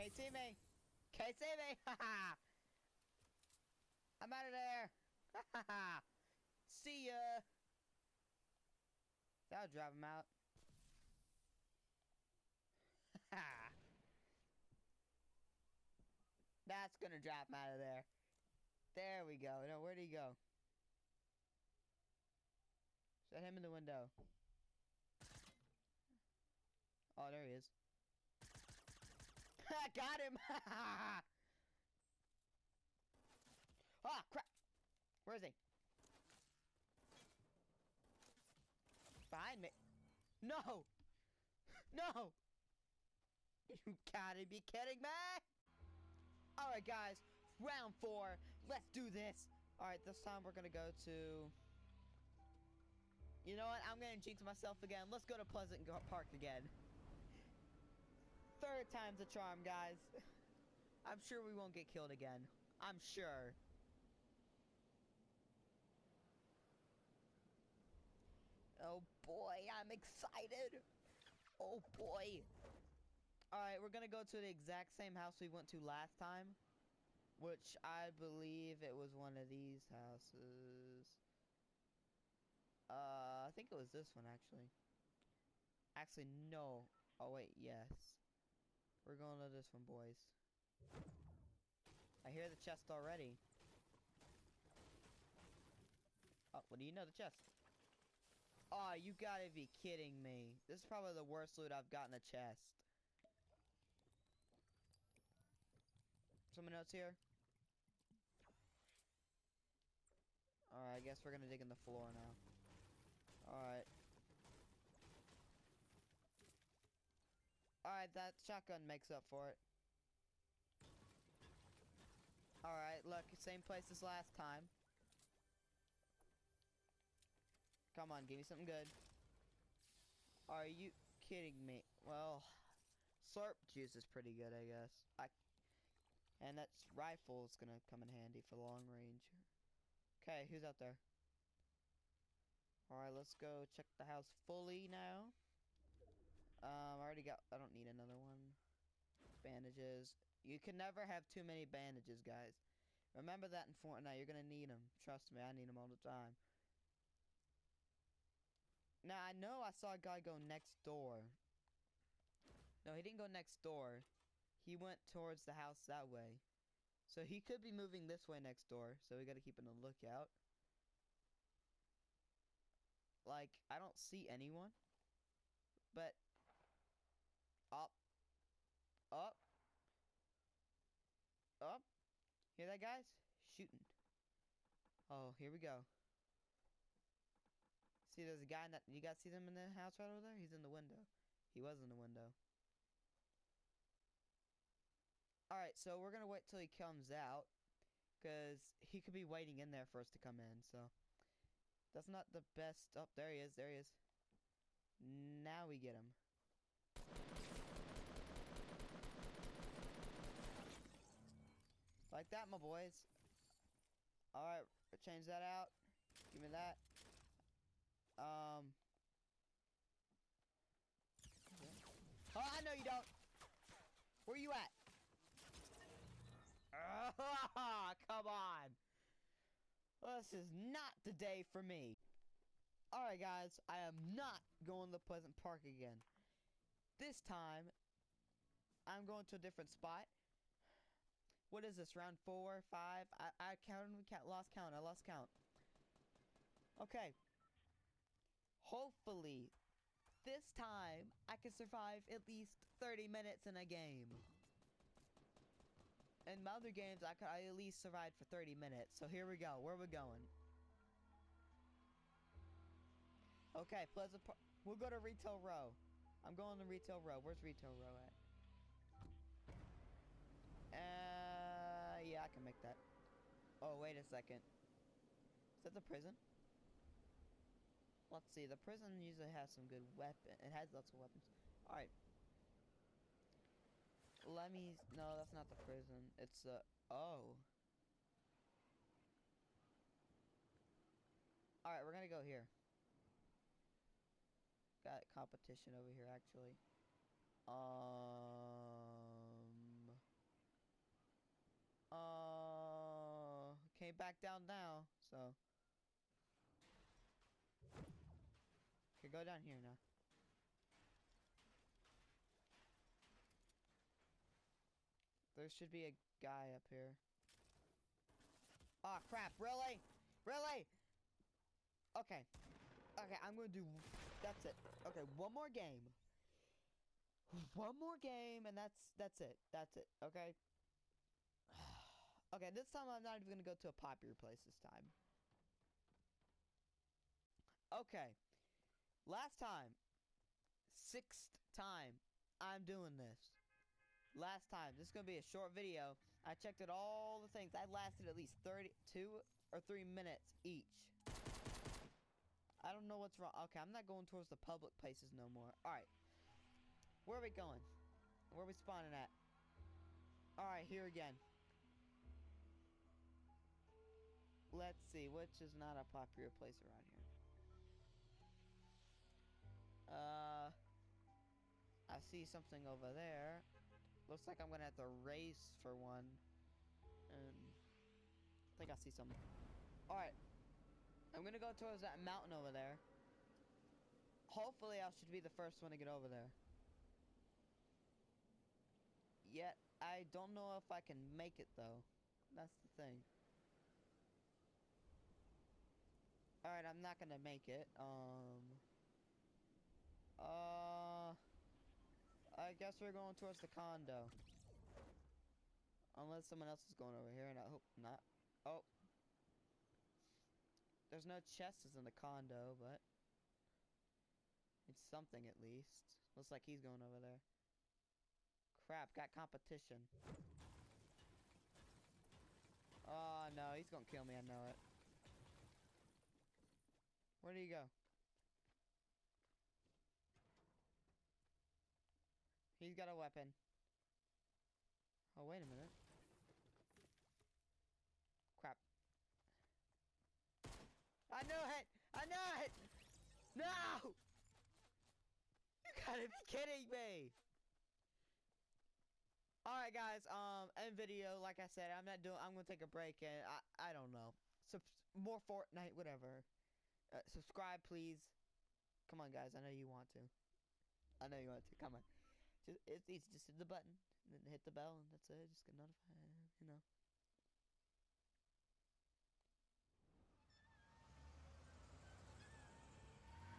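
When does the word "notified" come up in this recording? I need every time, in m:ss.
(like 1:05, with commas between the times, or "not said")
7:45.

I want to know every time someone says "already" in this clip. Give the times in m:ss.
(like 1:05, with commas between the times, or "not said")
1:32, 2:26.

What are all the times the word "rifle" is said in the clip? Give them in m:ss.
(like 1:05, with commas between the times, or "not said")
2:16.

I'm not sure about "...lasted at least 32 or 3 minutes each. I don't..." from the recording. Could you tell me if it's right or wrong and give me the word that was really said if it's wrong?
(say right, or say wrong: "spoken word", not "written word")
right.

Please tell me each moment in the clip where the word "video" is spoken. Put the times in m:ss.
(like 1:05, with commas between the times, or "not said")
5:45, 7:30.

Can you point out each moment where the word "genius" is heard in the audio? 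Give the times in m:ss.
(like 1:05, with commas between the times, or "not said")
not said.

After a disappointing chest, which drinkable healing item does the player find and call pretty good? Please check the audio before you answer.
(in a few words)
Slurp juice.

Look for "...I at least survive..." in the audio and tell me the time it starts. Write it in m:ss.
4:17.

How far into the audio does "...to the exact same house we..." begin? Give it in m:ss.
1:14.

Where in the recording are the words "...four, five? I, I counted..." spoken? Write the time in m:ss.
4:02.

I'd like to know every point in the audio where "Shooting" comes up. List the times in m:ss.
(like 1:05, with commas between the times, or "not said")
3:03.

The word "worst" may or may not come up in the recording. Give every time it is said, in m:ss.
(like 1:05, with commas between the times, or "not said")
1:41.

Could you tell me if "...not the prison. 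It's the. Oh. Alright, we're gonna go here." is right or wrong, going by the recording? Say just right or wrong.
right.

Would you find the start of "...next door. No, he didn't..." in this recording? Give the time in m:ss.
2:40.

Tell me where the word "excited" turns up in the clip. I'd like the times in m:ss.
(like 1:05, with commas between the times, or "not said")
1:09.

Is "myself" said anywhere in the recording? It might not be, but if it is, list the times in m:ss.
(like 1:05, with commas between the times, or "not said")
0:54.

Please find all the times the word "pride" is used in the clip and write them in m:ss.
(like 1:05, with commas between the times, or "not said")
not said.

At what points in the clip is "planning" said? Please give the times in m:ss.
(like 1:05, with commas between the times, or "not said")
not said.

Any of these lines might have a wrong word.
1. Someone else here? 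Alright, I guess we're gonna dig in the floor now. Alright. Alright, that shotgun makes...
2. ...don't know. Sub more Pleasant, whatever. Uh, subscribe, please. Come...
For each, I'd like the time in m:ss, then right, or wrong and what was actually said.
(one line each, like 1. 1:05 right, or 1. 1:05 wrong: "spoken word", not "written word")
1. 1:46 right
2. 7:33 wrong: "Fortnite", not "Pleasant".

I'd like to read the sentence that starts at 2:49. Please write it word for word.
So we gotta keep on the lookout.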